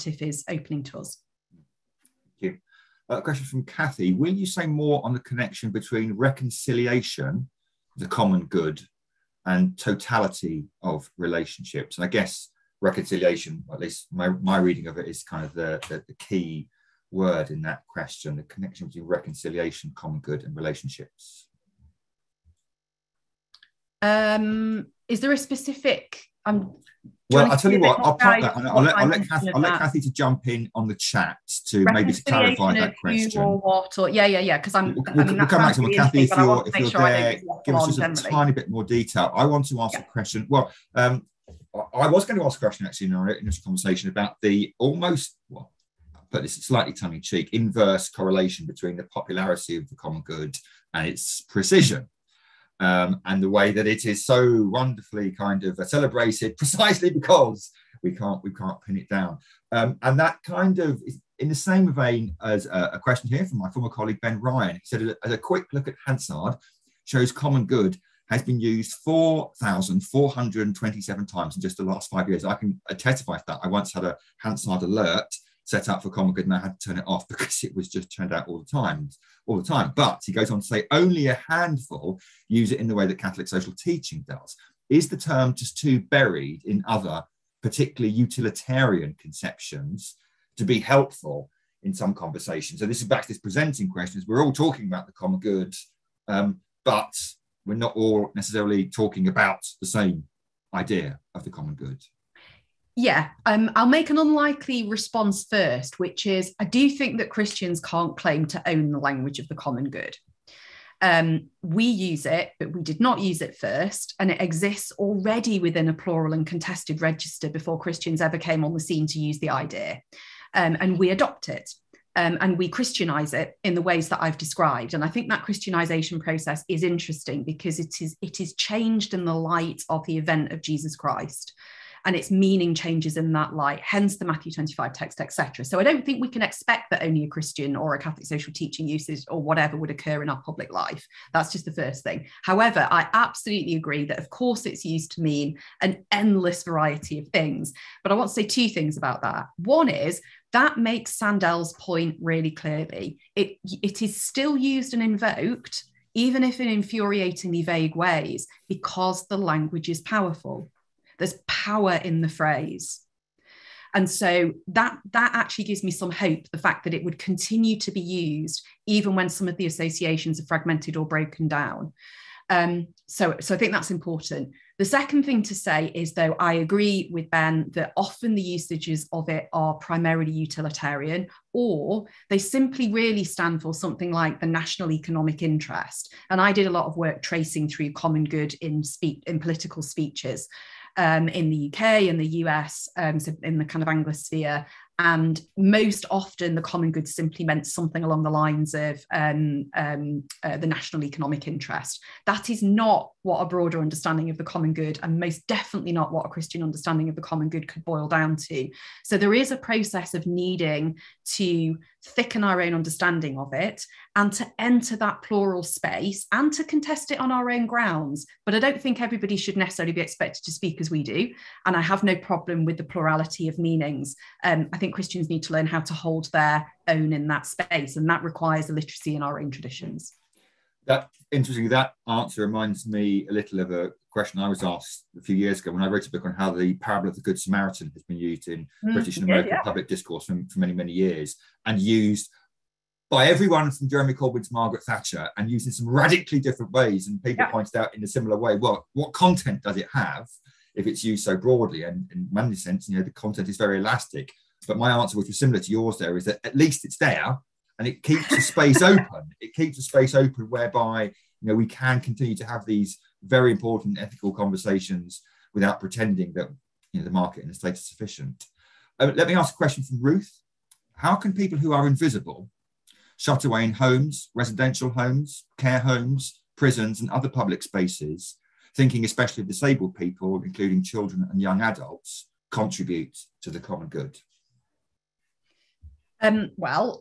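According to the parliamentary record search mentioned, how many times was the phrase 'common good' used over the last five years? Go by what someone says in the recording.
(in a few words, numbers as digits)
4,427.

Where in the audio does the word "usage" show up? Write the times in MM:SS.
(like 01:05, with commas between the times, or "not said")
02:18, 02:58.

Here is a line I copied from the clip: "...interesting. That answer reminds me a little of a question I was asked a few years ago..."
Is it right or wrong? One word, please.
right.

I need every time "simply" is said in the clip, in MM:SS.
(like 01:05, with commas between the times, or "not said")
03:02, 03:17.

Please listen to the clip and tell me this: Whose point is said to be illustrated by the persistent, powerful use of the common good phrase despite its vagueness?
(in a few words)
Sandel.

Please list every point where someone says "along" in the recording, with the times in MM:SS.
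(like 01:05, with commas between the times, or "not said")
03:18.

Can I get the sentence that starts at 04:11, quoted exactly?
And, in many sense, you know, the content is very elastic.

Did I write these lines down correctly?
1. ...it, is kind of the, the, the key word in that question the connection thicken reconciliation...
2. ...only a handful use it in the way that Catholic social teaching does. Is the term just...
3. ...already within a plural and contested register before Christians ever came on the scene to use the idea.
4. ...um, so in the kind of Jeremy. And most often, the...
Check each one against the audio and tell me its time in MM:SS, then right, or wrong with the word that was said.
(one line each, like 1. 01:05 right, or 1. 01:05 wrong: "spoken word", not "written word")
1. 00:14 wrong: "between", not "thicken"
2. 01:20 right
3. 01:54 right
4. 03:12 wrong: "Anglosphere", not "Jeremy".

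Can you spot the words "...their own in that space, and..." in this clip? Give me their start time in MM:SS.
03:46.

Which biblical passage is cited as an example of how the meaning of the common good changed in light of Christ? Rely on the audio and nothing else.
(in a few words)
Matthew 25.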